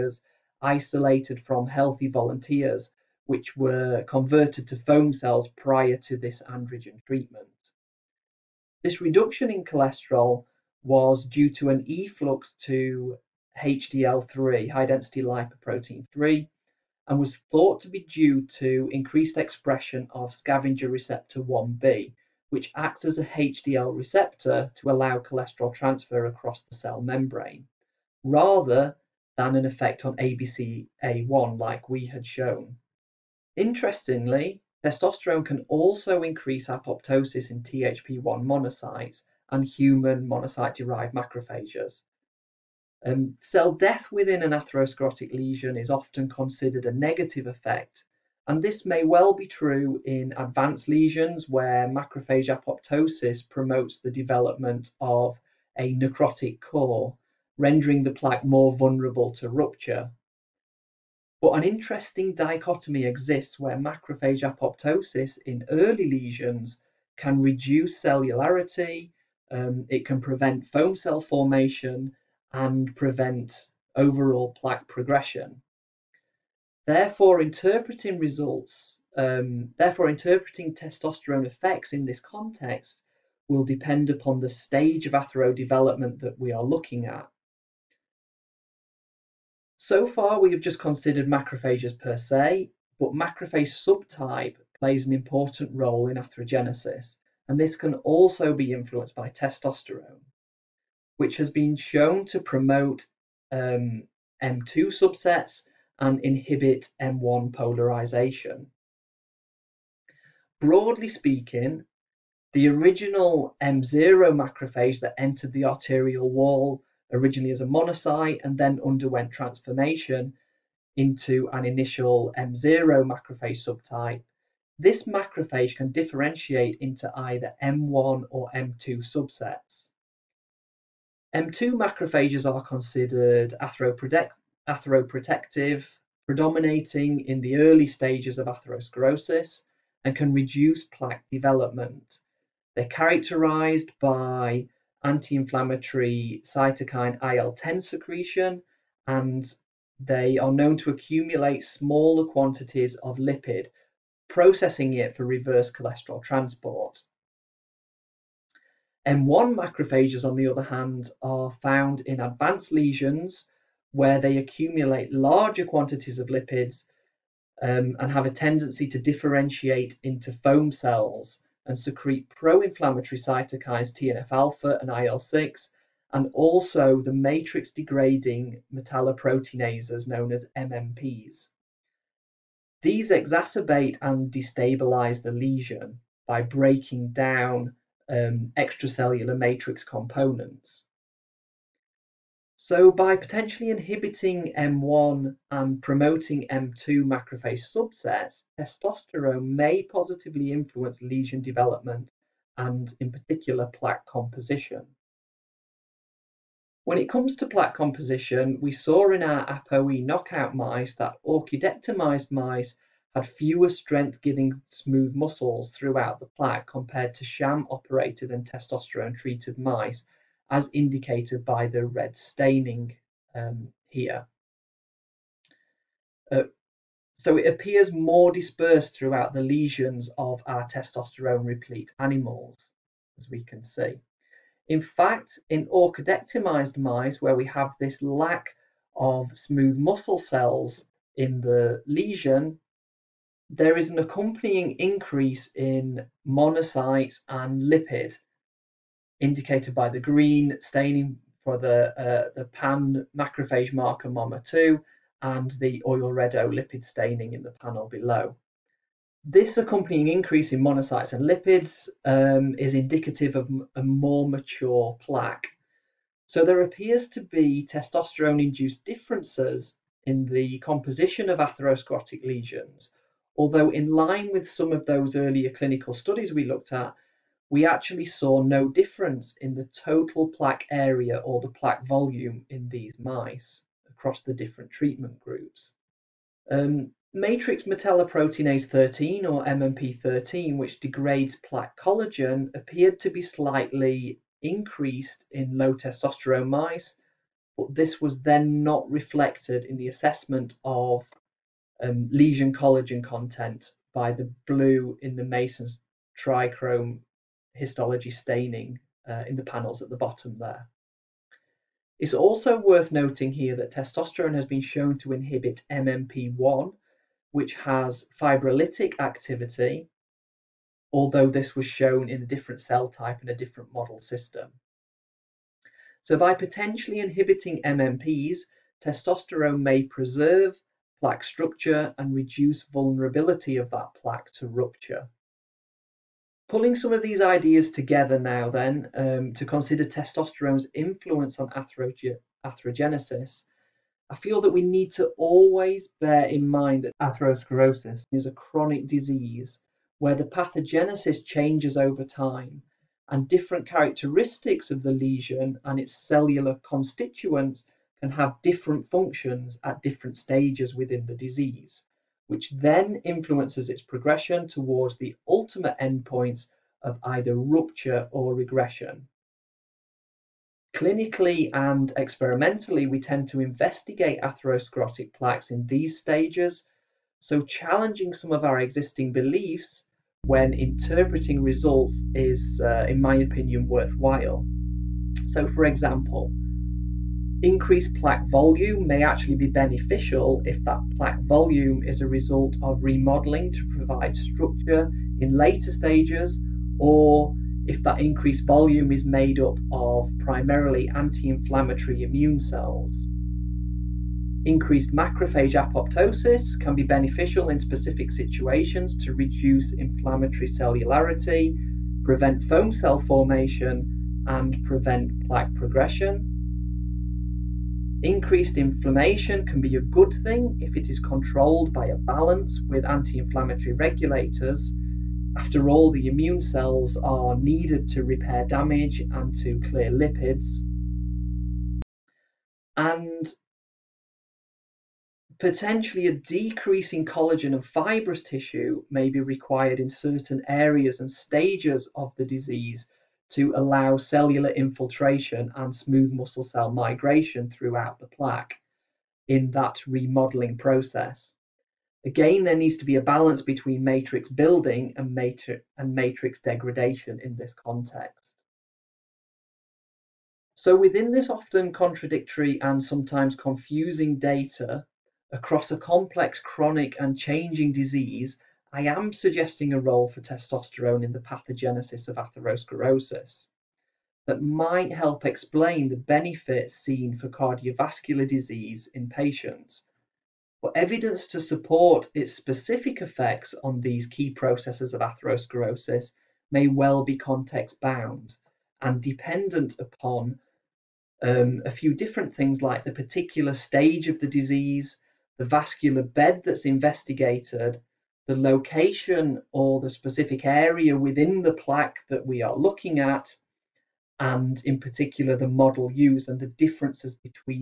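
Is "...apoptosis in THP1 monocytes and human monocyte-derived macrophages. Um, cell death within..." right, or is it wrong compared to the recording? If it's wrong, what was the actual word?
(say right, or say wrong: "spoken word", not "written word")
right.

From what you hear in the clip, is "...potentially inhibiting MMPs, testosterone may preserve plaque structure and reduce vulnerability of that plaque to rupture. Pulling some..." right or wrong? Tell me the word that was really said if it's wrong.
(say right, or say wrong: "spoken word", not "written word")
right.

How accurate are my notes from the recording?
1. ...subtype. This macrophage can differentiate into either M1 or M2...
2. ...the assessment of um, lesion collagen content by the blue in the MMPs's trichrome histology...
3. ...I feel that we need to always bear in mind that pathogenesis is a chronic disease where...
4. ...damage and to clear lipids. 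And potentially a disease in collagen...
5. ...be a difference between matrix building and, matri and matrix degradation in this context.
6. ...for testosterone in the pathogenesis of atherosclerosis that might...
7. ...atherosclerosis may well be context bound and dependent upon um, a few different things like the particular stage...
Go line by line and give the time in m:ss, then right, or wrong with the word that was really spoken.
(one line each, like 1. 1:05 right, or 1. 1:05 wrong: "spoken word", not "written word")
1. 2:03 right
2. 4:59 wrong: "Masson", not "MMPs"
3. 5:44 wrong: "atherosclerosis", not "pathogenesis"
4. 7:08 wrong: "decrease", not "disease"
5. 7:32 wrong: "balance", not "difference"
6. 7:50 right
7. 8:04 right.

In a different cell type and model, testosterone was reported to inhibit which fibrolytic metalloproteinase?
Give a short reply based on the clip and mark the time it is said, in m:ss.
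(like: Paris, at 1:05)
MMP1, at 5:15.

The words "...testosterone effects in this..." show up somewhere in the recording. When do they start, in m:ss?
1:20.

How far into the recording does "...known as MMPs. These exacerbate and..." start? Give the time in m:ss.
3:00.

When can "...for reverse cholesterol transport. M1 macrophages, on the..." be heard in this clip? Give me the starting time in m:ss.
2:35.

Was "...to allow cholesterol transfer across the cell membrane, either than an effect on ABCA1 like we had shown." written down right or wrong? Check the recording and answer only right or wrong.
wrong.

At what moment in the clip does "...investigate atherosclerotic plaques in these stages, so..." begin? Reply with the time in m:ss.
6:13.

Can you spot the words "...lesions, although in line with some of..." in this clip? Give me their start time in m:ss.
4:32.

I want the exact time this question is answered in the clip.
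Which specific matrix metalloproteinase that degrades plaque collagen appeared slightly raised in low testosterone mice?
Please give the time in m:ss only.
4:49.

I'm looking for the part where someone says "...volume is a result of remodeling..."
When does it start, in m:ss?
6:31.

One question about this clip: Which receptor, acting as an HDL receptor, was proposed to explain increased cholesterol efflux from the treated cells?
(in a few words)
scavenger receptor 1b.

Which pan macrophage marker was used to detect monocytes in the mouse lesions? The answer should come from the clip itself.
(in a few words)
MOMA2.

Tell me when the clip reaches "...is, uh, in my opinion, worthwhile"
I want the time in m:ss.
6:22.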